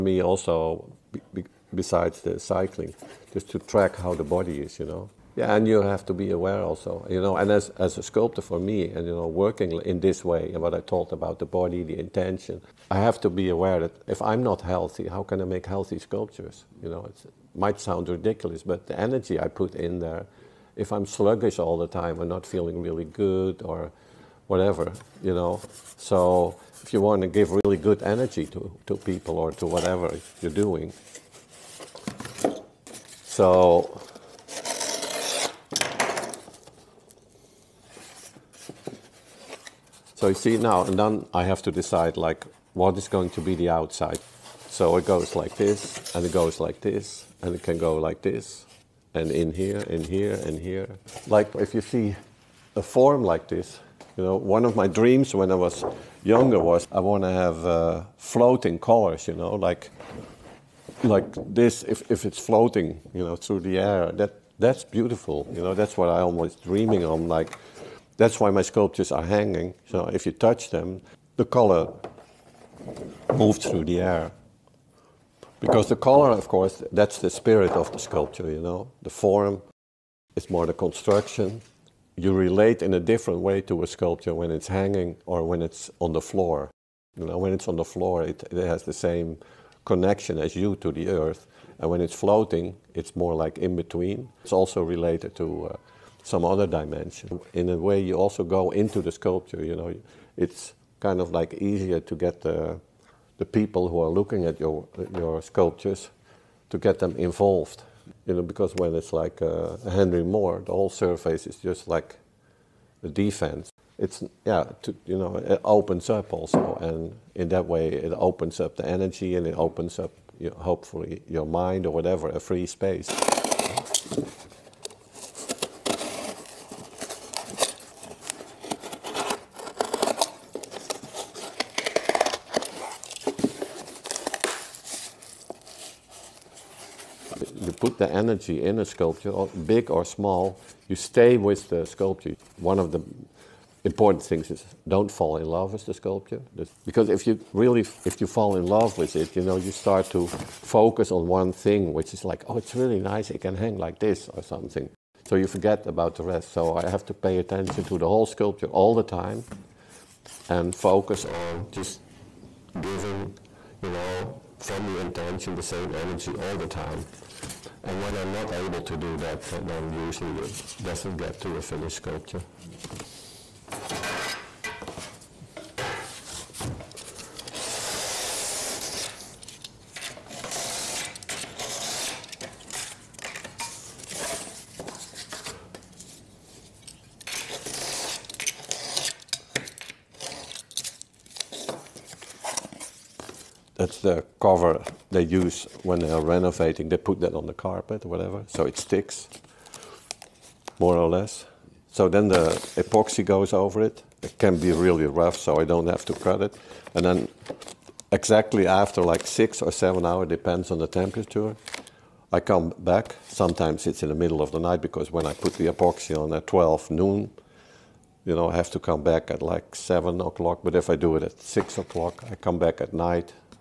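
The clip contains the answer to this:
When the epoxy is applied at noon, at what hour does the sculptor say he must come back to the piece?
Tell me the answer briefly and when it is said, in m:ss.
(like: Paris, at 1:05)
7 o'clock, at 3:39.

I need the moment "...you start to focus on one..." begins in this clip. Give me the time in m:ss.
2:29.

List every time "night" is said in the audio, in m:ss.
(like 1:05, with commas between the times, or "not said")
3:34, 3:42.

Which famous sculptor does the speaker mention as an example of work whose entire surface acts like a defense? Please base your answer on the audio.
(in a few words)
Henry Moore.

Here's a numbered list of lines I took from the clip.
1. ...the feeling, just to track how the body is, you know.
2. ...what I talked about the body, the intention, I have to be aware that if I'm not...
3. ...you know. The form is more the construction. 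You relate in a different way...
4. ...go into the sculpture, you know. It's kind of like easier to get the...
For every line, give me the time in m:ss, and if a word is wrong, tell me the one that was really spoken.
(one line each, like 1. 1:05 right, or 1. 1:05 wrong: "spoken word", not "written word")
1. 0:02 wrong: "cycling", not "feeling"
2. 0:10 right
3. 1:18 right
4. 1:38 right.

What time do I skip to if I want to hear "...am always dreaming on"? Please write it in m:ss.
1:06.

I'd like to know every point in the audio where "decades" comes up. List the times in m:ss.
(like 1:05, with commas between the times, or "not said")
not said.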